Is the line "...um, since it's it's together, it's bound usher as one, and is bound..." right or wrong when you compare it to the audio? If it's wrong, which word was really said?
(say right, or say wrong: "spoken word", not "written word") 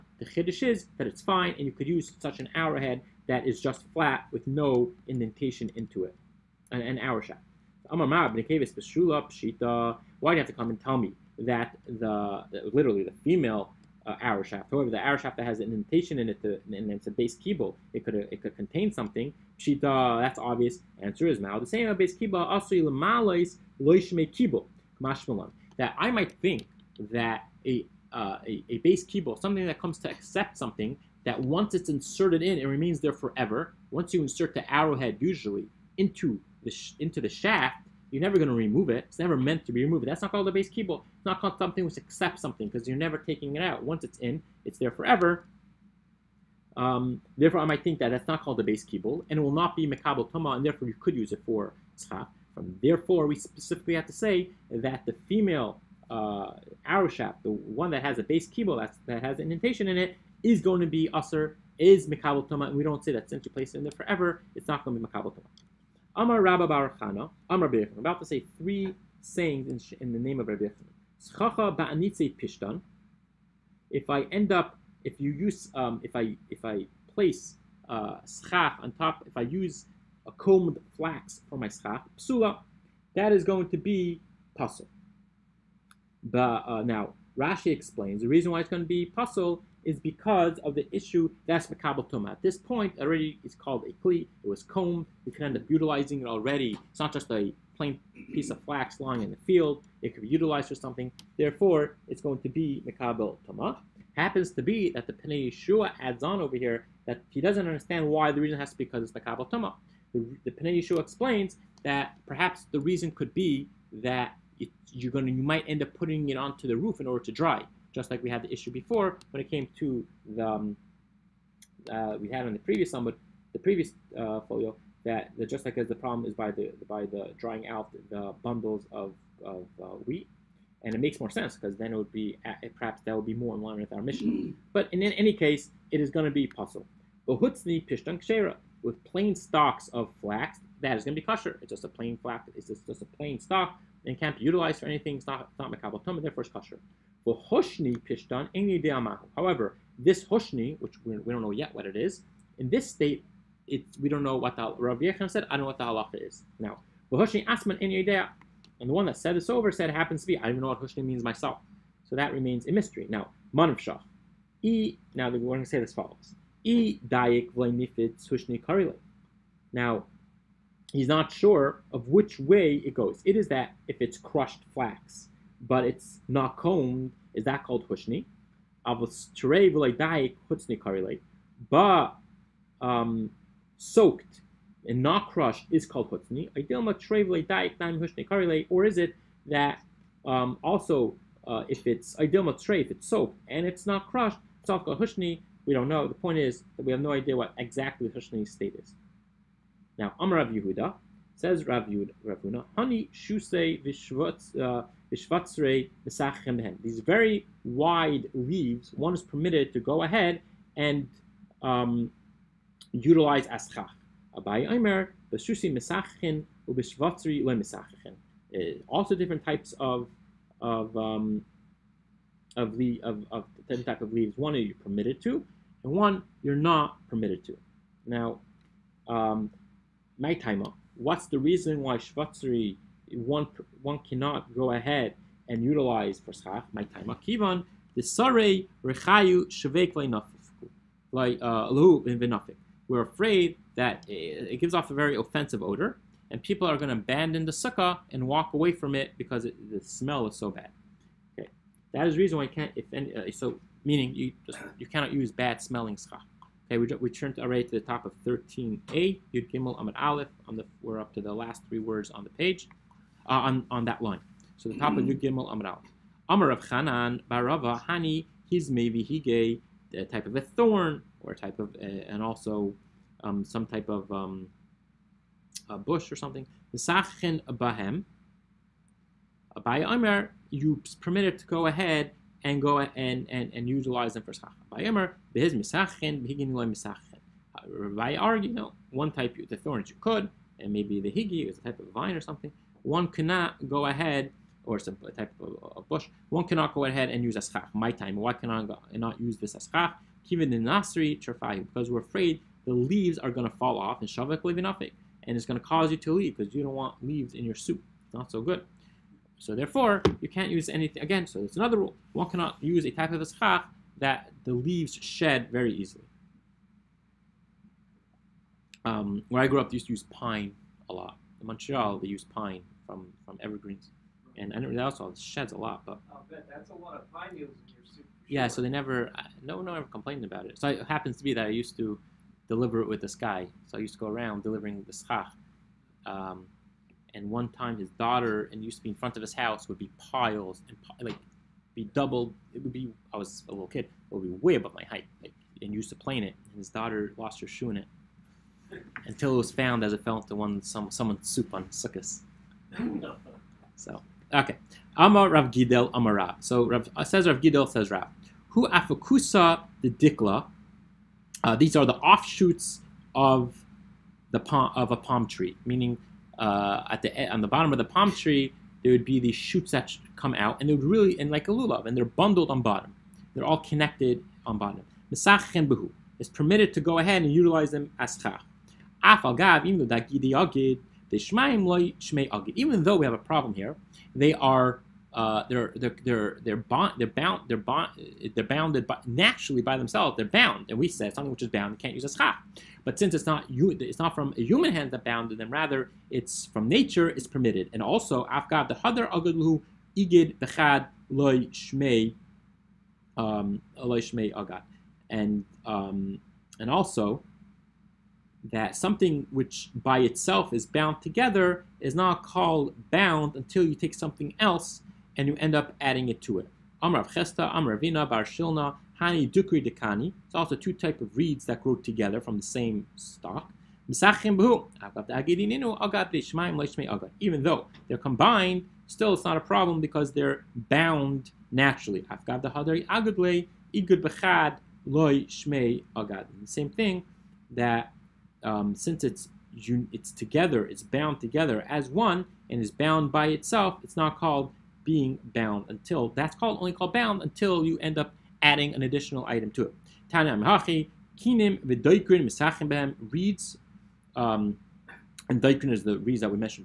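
wrong: "together", not "usher".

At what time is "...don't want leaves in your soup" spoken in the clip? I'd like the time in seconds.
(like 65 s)
306 s.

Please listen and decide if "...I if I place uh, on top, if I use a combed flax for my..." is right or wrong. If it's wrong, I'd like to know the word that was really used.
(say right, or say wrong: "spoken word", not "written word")
right.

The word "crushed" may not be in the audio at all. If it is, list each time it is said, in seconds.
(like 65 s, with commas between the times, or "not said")
174 s, 185 s, 194 s.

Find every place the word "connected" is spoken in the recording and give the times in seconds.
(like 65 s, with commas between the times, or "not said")
373 s.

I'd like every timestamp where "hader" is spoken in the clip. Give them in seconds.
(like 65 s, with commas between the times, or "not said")
398 s.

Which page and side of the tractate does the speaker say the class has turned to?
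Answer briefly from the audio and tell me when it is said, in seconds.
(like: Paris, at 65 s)
13a, at 258 s.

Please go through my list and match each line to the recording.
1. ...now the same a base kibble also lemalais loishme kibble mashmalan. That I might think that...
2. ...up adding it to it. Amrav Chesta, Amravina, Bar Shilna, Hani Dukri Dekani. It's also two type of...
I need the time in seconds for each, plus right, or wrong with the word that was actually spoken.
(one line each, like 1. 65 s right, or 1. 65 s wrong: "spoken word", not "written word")
1. 21 s right
2. 415 s right.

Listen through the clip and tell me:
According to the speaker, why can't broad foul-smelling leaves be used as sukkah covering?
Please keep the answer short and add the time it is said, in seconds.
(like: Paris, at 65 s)
abandon the sukkah, at 246 s.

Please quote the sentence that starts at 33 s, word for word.
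Once you insert the arrowhead, usually into the into the shaft, you're never going to remove it.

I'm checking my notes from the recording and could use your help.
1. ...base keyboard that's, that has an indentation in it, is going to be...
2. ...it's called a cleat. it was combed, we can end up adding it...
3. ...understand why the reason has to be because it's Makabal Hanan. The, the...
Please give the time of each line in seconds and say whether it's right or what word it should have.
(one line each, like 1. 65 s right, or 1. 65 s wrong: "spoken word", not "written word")
1. 58 s right
2. 93 s wrong: "utilizing", not "adding"
3. 107 s wrong: "Tuma", not "Hanan".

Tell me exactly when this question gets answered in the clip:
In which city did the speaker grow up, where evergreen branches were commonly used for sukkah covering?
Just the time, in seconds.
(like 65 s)
321 s.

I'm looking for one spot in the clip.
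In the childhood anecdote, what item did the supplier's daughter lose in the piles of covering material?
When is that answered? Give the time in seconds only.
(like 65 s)
347 s.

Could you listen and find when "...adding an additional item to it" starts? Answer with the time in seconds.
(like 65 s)
448 s.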